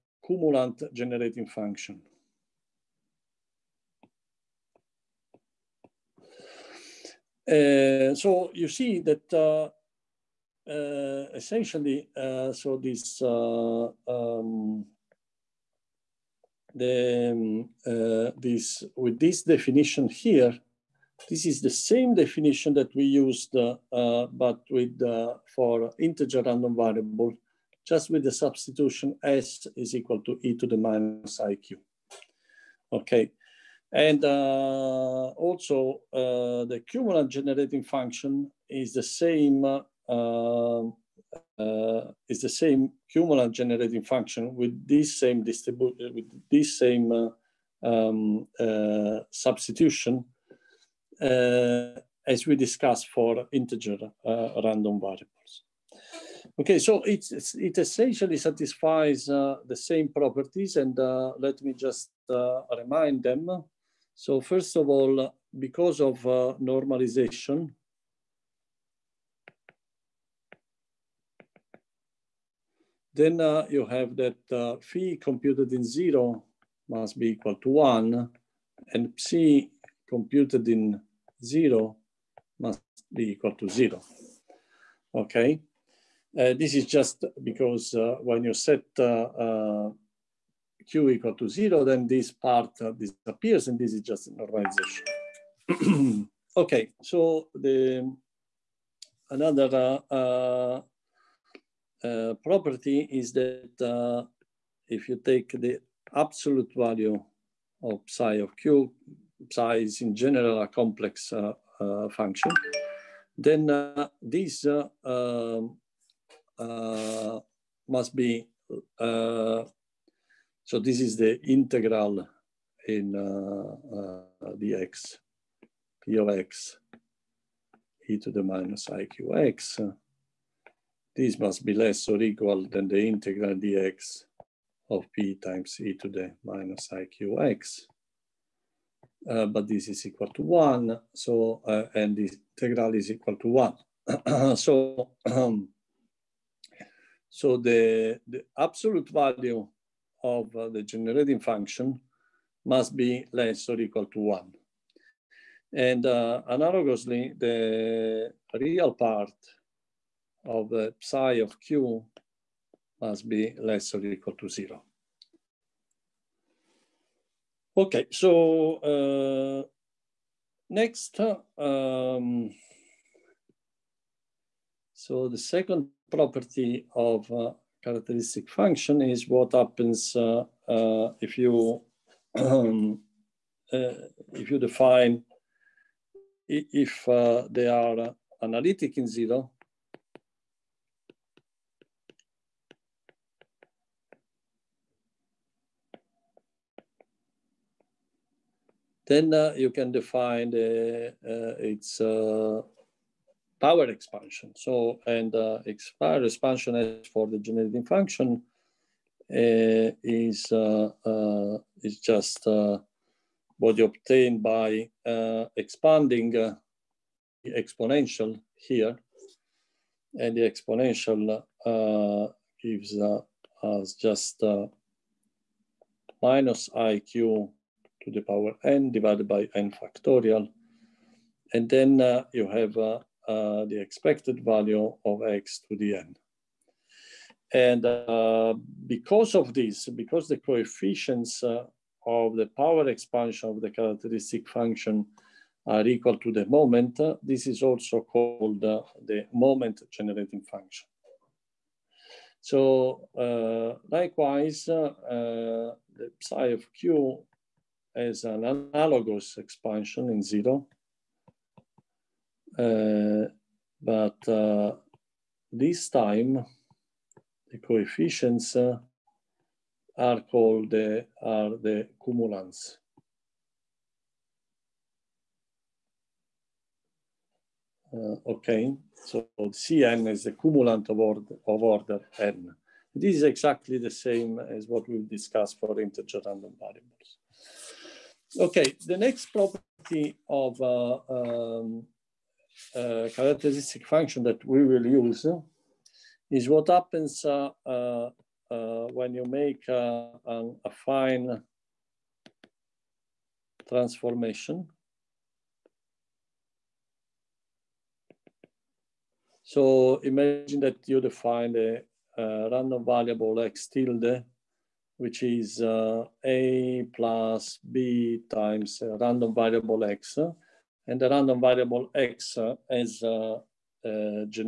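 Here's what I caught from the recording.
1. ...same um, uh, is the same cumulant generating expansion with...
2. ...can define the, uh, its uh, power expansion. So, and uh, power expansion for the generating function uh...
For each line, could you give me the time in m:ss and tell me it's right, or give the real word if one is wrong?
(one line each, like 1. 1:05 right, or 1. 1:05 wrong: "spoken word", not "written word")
1. 0:39 wrong: "function", not "expansion"
2. 3:19 right.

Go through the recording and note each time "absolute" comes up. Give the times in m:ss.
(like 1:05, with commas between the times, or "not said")
1:46, 2:28.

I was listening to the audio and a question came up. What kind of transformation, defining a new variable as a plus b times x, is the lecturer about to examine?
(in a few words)
affine transformation.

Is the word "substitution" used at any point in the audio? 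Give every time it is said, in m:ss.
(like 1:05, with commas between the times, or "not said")
0:28, 0:49.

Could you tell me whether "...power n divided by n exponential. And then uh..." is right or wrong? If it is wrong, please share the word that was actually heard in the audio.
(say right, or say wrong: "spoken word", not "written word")
wrong: "factorial", not "exponential".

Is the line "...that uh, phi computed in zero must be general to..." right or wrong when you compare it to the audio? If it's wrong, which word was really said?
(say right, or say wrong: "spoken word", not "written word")
wrong: "equal", not "general".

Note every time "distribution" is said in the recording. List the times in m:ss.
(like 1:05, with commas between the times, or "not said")
0:45.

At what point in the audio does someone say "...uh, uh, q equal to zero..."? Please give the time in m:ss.
1:28.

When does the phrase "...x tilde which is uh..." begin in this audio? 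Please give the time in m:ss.
5:13.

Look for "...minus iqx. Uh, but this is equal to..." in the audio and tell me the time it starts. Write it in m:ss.
2:16.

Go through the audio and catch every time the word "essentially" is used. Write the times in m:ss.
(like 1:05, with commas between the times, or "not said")
0:11, 0:57.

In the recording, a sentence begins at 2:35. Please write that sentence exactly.
And uh, analogously, the real part of the psi of q must be less or equal to zero.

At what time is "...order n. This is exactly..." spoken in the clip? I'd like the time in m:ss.
4:41.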